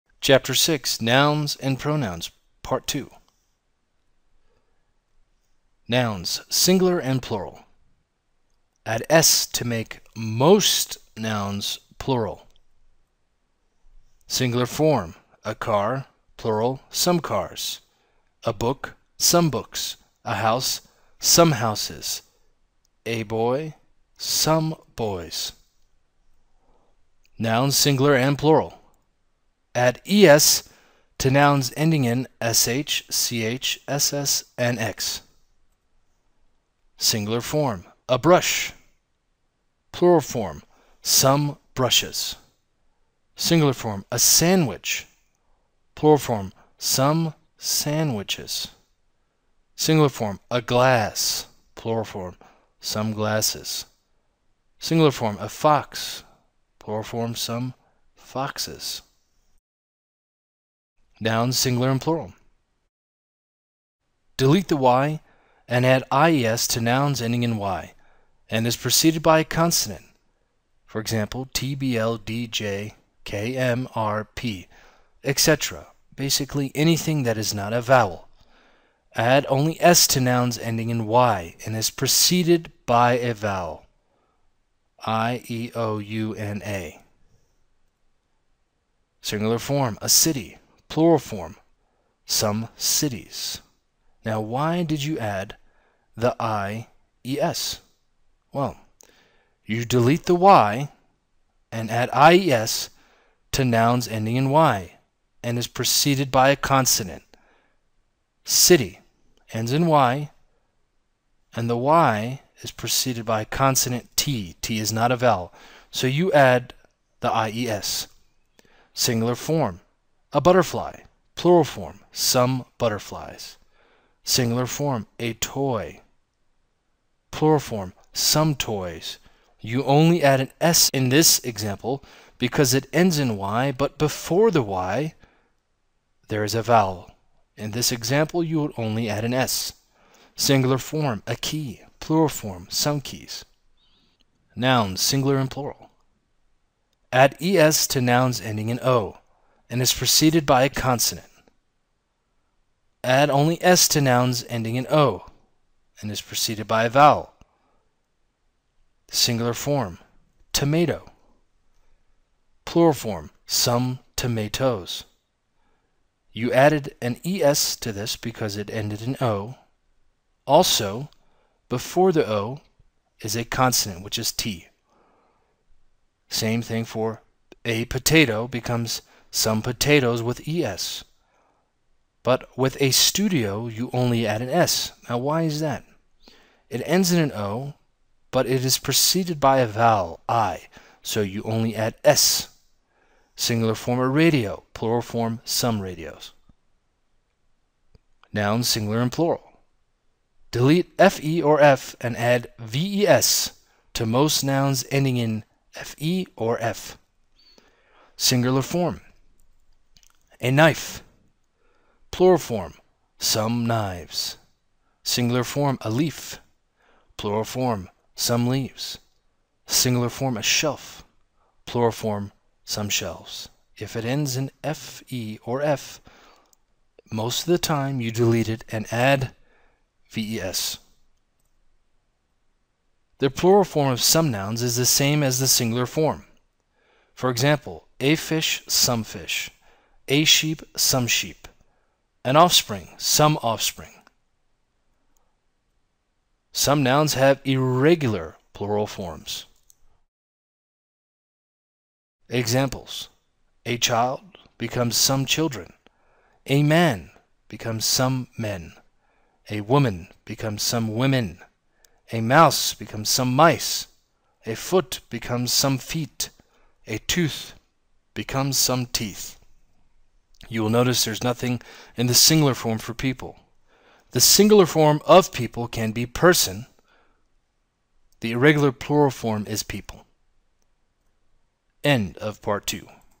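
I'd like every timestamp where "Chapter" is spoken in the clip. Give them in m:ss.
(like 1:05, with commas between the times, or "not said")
0:00.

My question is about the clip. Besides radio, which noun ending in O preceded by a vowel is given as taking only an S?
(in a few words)
studio.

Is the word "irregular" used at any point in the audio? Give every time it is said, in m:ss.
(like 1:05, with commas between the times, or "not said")
4:07, 4:38.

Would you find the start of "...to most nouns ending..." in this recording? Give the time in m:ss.
3:23.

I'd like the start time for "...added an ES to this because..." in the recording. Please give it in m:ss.
2:46.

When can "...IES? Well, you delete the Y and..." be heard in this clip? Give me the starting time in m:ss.
1:36.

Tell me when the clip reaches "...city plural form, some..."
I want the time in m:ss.
1:30.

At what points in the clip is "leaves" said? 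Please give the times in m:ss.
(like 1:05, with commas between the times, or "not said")
3:38.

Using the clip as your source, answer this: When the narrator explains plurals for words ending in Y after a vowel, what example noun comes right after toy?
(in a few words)
key.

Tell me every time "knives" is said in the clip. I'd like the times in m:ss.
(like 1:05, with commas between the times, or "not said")
3:33.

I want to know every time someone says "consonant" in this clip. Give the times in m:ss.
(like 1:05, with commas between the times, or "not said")
1:09, 1:46, 1:53, 2:30, 2:53.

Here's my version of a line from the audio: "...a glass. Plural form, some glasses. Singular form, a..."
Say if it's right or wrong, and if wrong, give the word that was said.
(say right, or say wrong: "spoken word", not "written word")
right.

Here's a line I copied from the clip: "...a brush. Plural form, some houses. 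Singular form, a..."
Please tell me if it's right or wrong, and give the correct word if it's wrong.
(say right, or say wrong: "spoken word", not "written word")
wrong: "brushes", not "houses".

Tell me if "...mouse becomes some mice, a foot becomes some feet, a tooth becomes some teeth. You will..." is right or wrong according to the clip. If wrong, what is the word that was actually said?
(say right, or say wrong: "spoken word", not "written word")
right.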